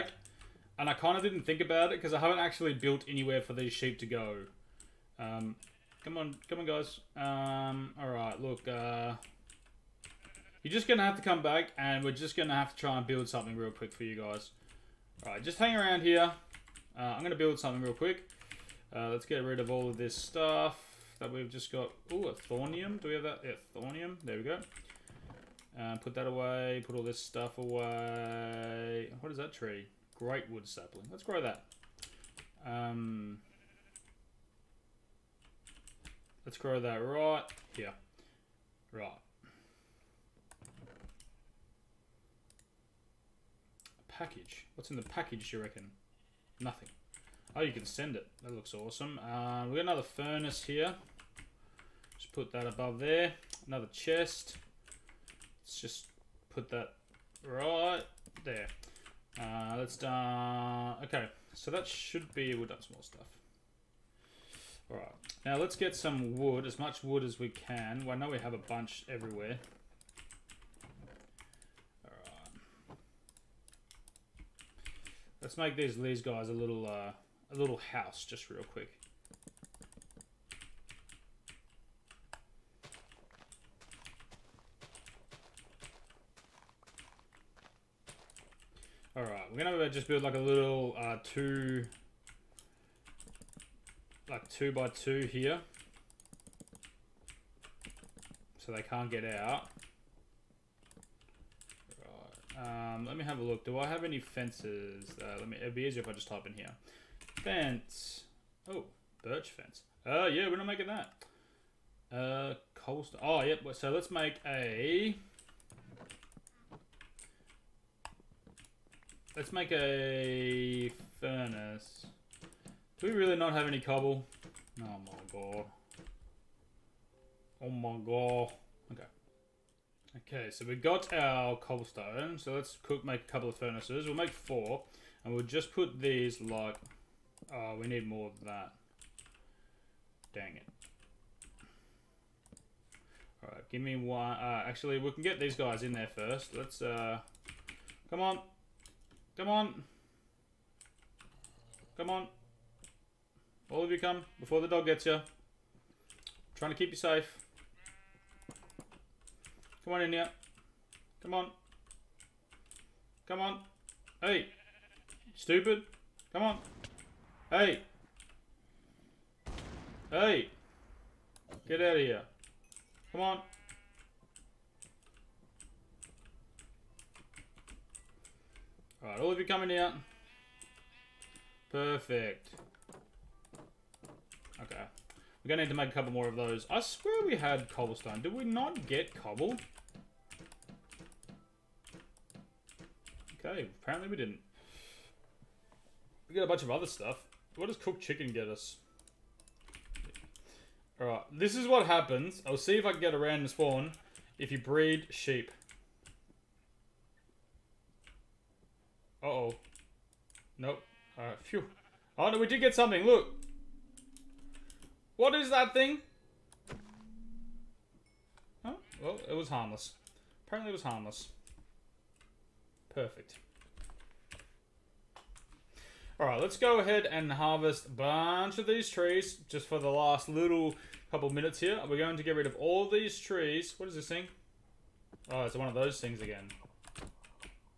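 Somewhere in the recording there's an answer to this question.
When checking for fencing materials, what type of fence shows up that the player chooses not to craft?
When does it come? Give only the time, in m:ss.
1:49.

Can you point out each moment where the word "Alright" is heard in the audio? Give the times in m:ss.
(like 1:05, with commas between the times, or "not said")
0:07, 0:15, 2:23, 2:59, 3:20, 3:31.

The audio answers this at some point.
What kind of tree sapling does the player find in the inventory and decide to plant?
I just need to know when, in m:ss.
0:30.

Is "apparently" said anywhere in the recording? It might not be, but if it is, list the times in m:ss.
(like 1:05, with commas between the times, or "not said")
3:13, 3:40.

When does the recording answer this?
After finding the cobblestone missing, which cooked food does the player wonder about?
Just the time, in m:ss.
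3:17.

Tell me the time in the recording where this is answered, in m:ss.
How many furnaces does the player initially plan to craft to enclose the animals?
2:14.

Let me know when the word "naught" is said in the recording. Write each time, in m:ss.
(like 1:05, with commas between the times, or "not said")
not said.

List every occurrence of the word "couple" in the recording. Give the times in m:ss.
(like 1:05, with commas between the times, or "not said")
2:13, 3:05, 3:51.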